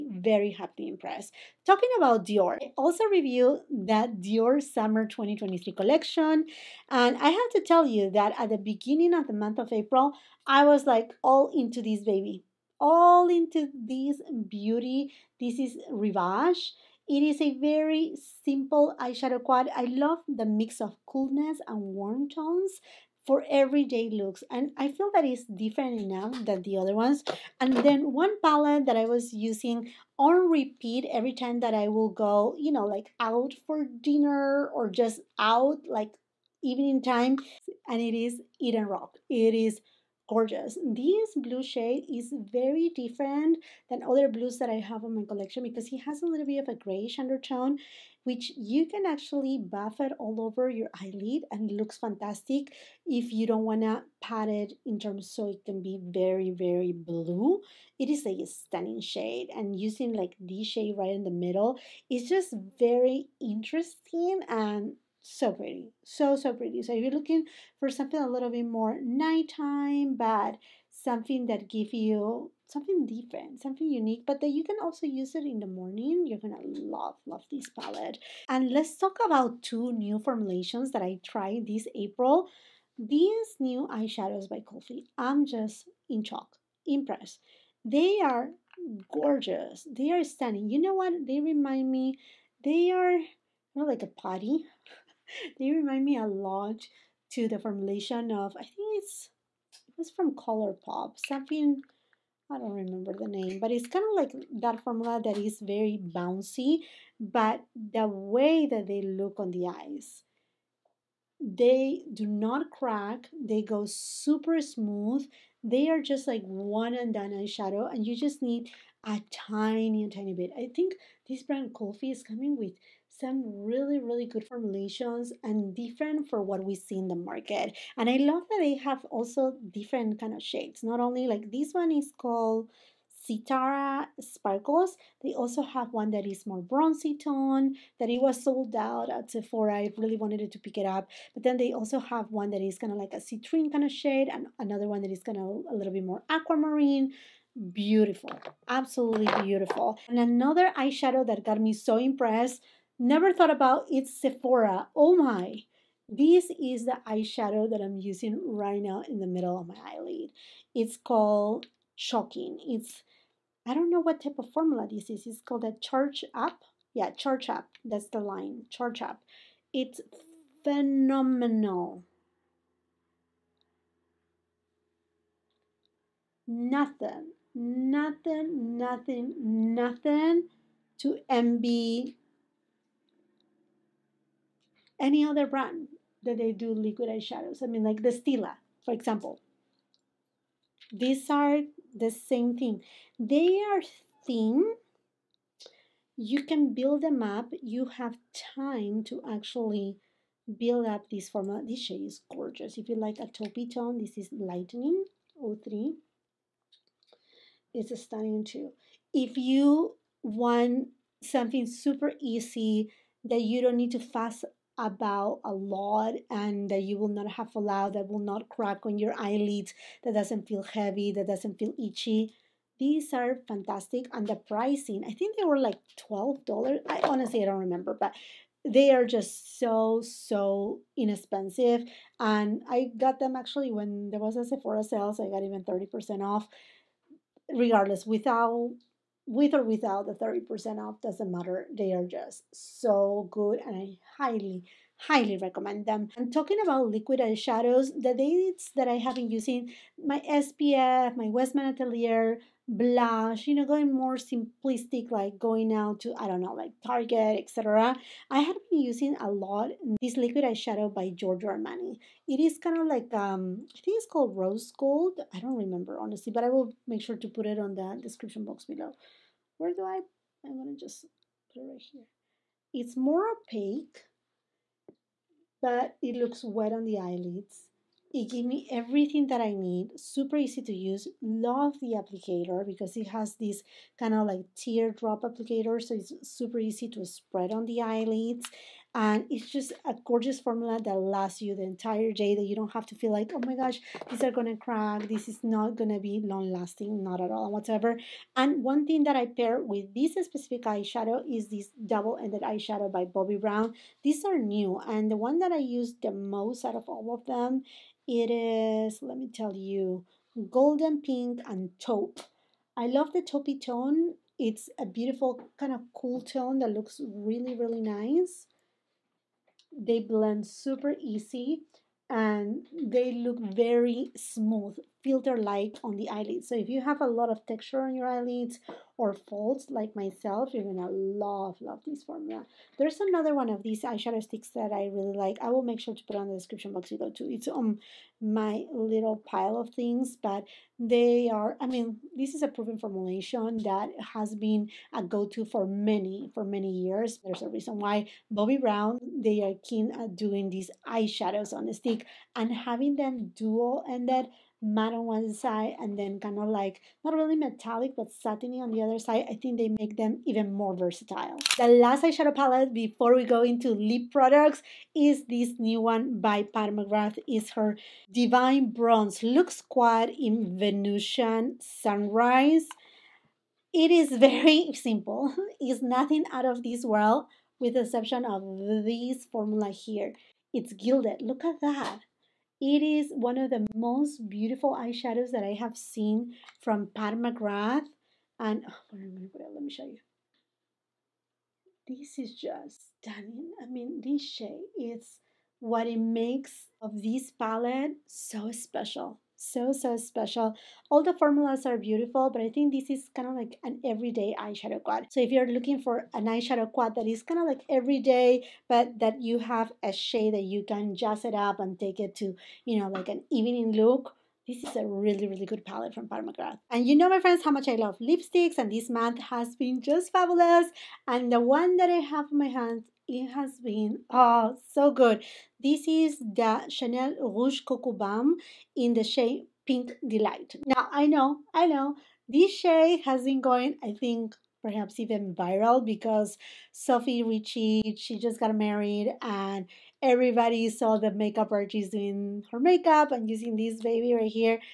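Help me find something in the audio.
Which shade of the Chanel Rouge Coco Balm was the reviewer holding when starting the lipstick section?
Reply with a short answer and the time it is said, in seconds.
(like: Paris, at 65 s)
Pink Delight, at 429 s.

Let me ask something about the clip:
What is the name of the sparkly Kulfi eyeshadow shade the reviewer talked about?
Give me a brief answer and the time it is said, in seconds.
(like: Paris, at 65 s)
Sitara Sparkles, at 133 s.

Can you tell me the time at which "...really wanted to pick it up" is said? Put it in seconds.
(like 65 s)
139 s.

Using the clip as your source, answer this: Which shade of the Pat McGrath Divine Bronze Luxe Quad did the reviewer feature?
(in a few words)
Venusian Sunrise.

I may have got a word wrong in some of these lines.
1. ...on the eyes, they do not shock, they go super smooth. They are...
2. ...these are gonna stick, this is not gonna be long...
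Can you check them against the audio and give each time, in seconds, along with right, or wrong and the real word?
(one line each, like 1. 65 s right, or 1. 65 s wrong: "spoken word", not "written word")
1. 109 s wrong: "crack", not "shock"
2. 294 s wrong: "crack", not "stick".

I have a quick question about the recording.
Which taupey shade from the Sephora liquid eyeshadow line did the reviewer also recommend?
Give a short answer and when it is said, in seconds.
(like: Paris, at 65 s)
Lightning 03, at 204 s.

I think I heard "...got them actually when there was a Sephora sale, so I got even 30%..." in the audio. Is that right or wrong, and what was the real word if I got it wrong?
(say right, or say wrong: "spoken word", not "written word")
right.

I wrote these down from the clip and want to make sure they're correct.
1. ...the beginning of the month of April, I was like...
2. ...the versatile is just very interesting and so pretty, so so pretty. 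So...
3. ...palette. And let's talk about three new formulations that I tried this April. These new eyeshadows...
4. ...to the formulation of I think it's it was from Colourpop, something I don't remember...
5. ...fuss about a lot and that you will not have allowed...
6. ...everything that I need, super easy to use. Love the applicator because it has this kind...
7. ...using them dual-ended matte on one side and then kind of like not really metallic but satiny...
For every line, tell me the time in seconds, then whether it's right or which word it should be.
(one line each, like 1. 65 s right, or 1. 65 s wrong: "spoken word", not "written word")
1. 8 s right
2. 61 s wrong: "middle", not "versatile"
3. 77 s wrong: "two", not "three"
4. 97 s right
5. 213 s right
6. 278 s right
7. 352 s wrong: "having", not "using".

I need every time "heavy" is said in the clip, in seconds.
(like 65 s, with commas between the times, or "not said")
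220 s.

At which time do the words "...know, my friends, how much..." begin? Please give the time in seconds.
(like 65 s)
416 s.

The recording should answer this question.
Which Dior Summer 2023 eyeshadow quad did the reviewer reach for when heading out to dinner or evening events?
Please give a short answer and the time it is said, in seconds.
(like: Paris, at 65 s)
Eden Rock, at 38 s.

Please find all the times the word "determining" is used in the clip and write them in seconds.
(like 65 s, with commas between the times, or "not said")
not said.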